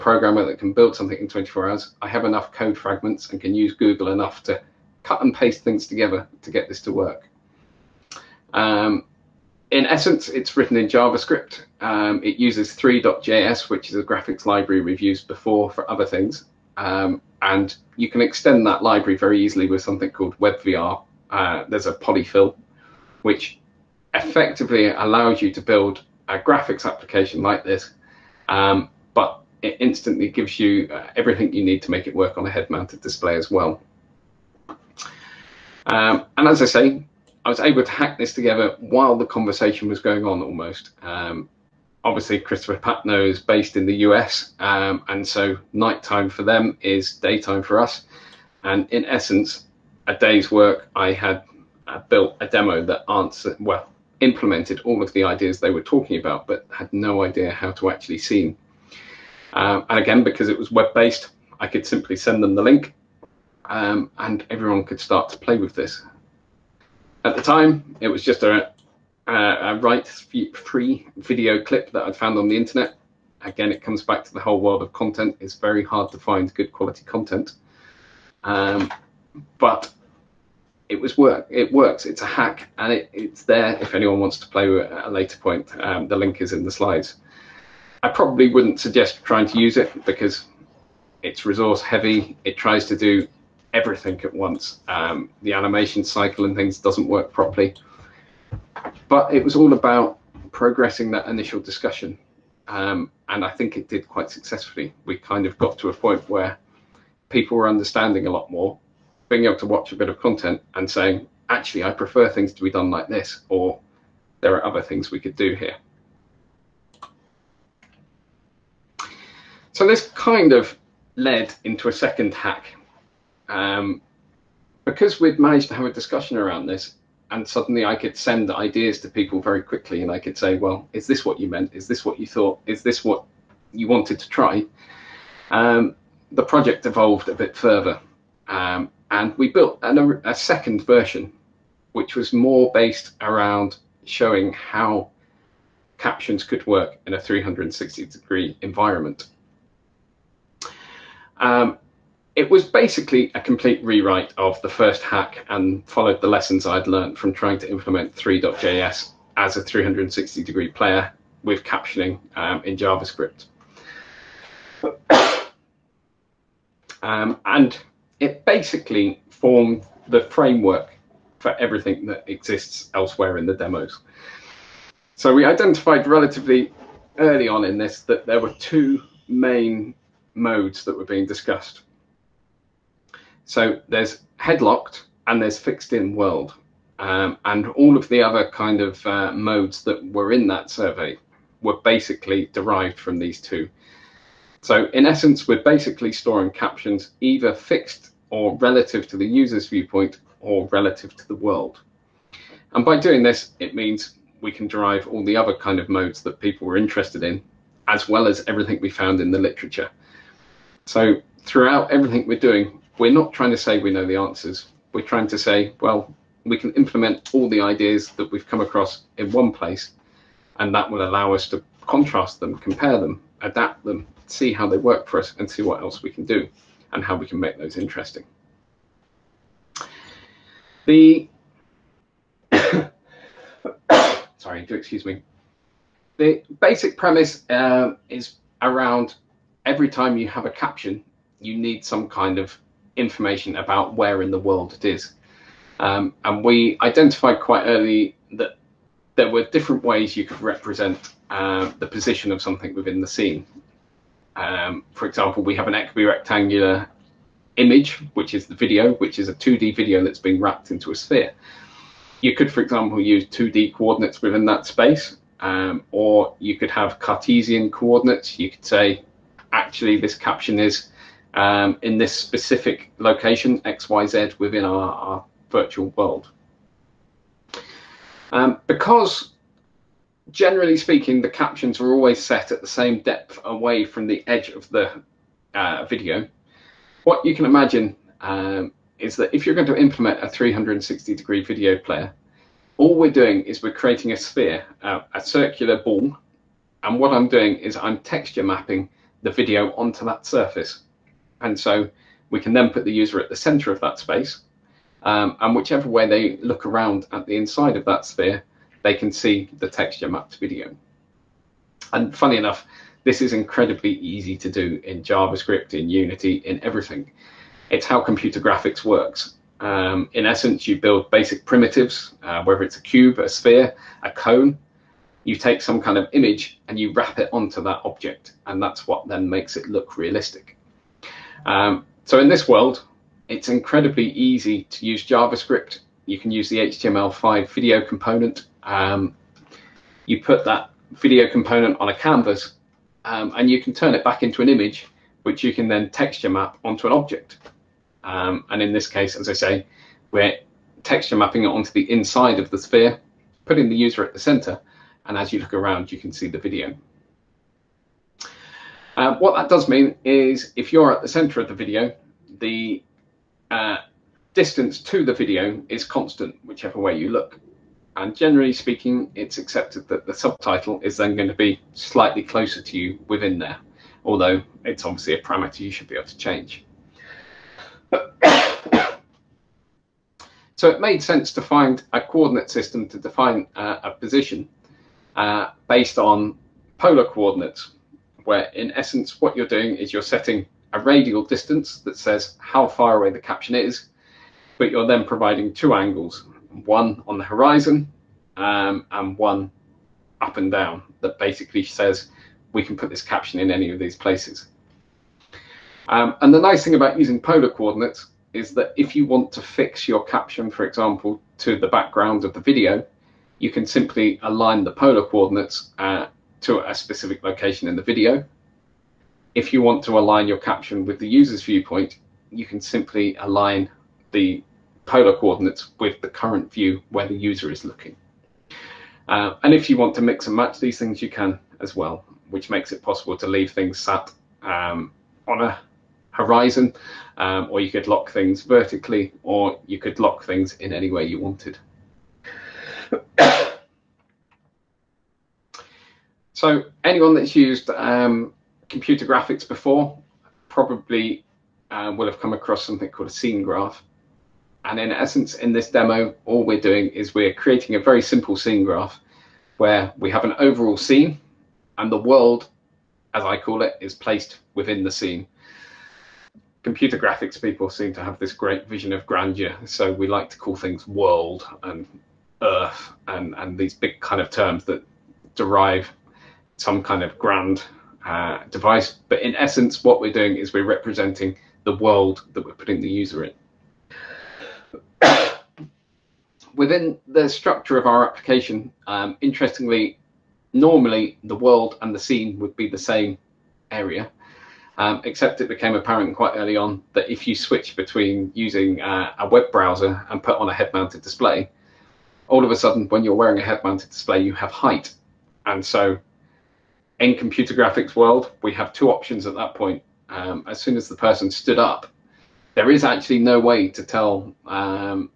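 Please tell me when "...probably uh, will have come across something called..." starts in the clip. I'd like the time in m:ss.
7:30.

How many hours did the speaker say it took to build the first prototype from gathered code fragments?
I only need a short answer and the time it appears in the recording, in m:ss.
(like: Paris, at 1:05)
24, at 0:01.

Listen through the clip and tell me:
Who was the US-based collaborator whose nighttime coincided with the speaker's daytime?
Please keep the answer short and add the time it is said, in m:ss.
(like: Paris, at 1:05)
Christopher Patnoe, at 0:42.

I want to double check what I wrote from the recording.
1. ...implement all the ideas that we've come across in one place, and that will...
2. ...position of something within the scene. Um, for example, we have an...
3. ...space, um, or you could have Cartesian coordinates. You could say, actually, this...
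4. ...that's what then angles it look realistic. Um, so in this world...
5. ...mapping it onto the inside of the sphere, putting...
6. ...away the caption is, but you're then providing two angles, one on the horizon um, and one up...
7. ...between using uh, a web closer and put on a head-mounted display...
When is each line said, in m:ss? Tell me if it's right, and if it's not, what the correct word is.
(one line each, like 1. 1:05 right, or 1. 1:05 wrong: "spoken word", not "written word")
1. 3:36 right
2. 4:11 right
3. 4:24 right
4. 5:28 wrong: "makes", not "angles"
5. 5:51 right
6. 6:32 right
7. 8:17 wrong: "browser", not "closer".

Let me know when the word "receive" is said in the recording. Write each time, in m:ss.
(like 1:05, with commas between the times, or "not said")
not said.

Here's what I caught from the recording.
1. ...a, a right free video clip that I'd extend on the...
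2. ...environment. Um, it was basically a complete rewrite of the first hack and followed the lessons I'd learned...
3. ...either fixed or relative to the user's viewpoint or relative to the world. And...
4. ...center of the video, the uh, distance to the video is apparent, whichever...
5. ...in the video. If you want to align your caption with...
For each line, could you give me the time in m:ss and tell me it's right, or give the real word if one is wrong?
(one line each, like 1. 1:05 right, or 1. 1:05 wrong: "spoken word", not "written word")
1. 1:09 wrong: "found", not "extend"
2. 2:28 right
3. 3:17 right
4. 6:01 wrong: "constant", not "apparent"
5. 6:57 right.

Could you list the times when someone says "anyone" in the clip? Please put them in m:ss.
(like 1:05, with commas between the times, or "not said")
1:23, 7:26.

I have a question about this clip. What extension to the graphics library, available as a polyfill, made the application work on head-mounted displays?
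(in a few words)
WebVR.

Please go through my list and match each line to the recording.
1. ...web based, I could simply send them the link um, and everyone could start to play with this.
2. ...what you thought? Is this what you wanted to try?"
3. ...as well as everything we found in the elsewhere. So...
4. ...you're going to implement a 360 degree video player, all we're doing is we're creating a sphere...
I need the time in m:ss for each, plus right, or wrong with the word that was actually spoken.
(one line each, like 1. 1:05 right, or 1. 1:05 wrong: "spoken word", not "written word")
1. 1:00 right
2. 2:12 right
3. 3:27 wrong: "literature", not "elsewhere"
4. 4:49 right.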